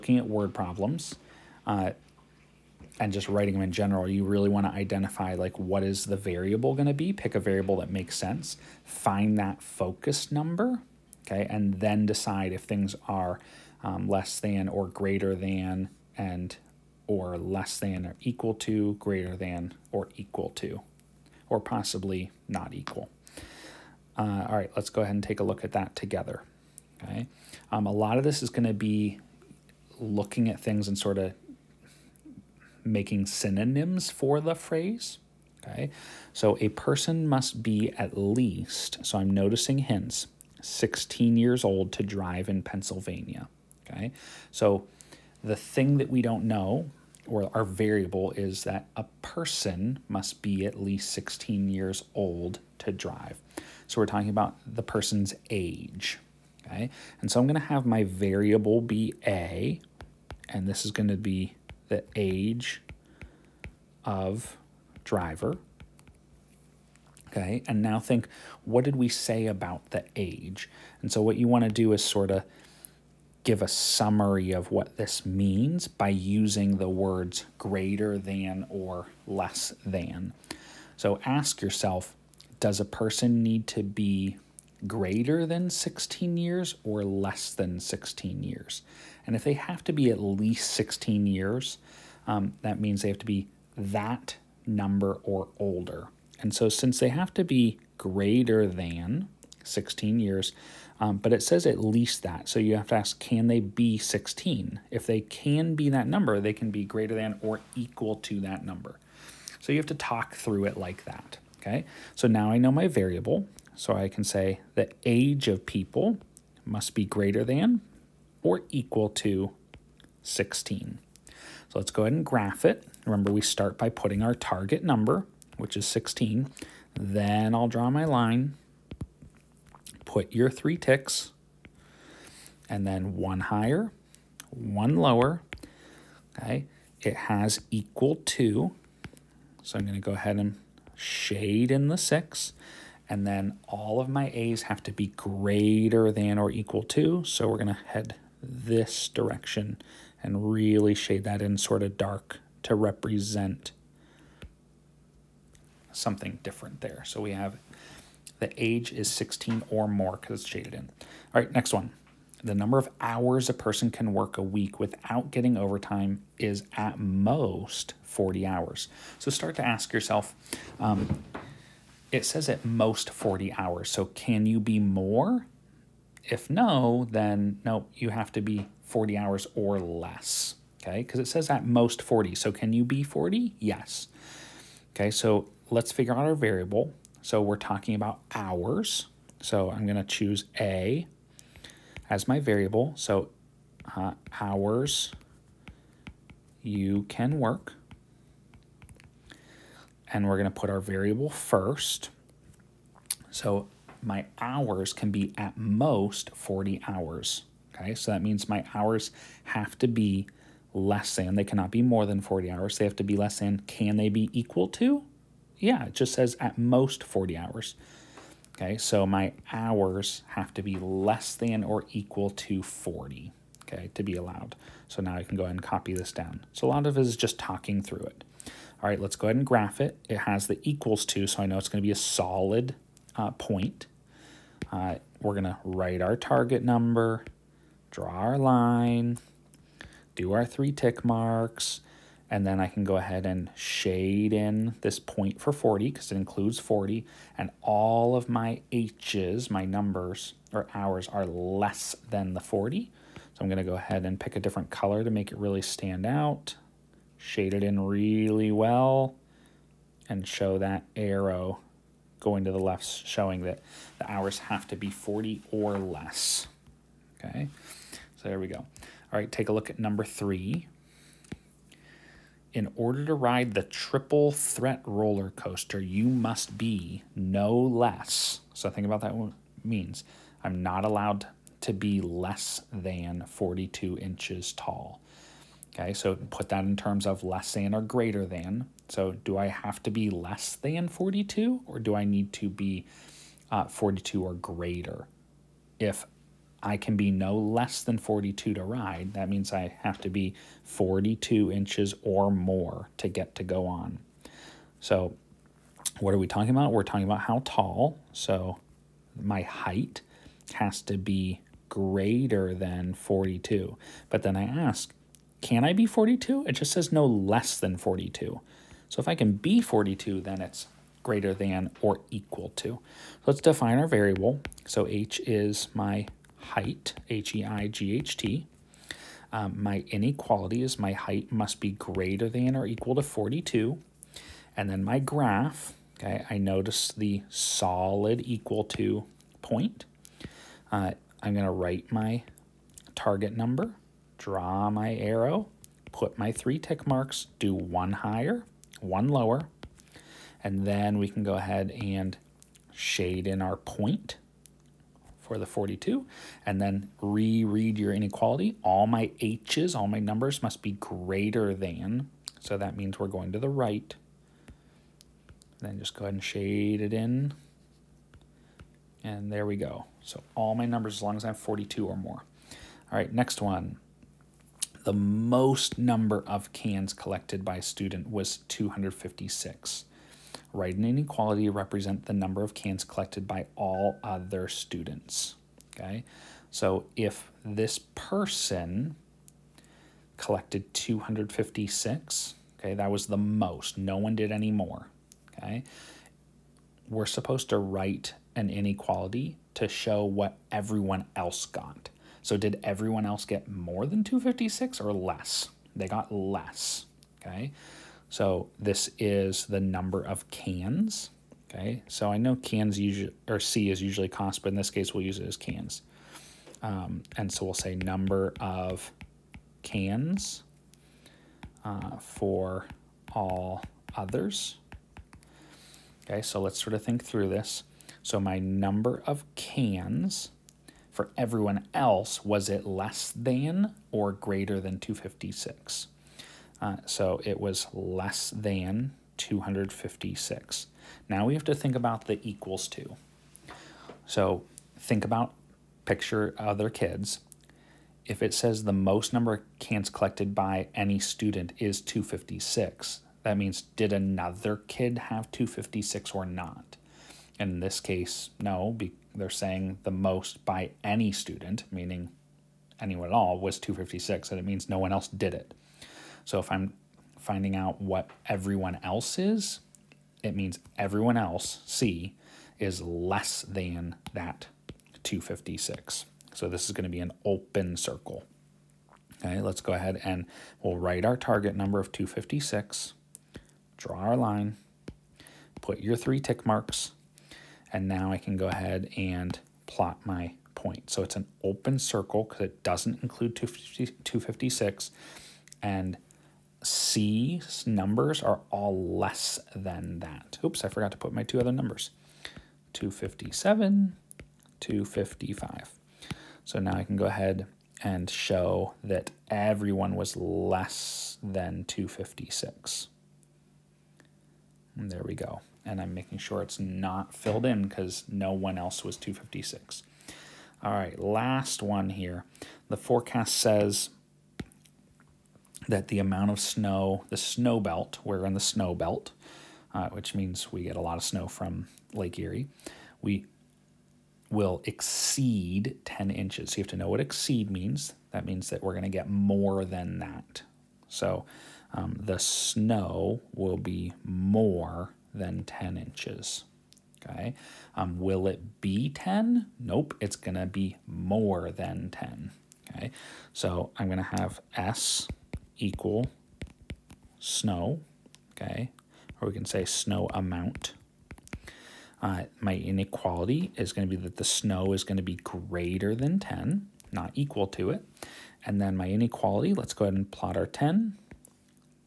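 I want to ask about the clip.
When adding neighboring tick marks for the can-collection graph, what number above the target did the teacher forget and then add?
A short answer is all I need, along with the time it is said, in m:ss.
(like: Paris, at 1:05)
257, at 8:22.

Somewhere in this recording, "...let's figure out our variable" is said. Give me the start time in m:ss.
3:05.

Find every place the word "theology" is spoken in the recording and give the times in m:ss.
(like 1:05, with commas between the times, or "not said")
not said.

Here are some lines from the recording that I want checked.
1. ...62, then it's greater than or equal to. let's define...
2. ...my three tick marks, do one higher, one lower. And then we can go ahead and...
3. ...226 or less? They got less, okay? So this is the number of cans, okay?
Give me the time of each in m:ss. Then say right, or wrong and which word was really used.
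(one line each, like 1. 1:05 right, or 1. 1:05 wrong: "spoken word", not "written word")
1. 5:19 wrong: "42", not "62"
2. 5:46 right
3. 6:44 wrong: "256", not "226".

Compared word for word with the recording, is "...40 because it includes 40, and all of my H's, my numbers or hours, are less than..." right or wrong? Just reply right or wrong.
right.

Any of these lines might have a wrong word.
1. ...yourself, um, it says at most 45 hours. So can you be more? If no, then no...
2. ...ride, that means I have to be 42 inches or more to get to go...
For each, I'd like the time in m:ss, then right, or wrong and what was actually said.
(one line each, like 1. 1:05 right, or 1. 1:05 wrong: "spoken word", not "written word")
1. 2:49 wrong: "40", not "45"
2. 4:58 right.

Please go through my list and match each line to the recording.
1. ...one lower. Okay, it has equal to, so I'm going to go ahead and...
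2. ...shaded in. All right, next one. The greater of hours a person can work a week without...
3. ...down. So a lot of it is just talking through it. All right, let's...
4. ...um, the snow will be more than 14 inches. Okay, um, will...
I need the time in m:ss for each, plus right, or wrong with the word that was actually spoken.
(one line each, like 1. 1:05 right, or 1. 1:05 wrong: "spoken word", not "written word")
1. 2:14 right
2. 2:40 wrong: "number", not "greater"
3. 3:46 right
4. 9:01 wrong: "10", not "14".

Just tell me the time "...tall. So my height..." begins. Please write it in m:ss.
5:07.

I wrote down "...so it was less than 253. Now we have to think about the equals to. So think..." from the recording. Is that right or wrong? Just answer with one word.
wrong.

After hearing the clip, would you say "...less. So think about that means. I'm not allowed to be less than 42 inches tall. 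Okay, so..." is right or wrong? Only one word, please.
right.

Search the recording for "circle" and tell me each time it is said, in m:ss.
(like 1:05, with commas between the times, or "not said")
7:57, 8:11.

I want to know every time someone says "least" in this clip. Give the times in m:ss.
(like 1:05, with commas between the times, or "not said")
0:38, 0:50, 1:30, 1:41.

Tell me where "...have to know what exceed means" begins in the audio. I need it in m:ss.
8:56.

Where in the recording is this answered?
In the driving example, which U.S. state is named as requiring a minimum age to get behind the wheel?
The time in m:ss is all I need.
0:42.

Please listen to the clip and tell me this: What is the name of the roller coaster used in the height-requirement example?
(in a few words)
triple threat.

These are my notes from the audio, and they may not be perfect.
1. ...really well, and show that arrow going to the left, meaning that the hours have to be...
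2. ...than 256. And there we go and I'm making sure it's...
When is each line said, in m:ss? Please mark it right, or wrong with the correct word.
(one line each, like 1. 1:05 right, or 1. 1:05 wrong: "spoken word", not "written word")
1. 4:17 wrong: "showing", not "meaning"
2. 8:31 right.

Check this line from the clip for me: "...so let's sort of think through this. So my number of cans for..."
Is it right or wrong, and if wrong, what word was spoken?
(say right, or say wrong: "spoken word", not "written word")
right.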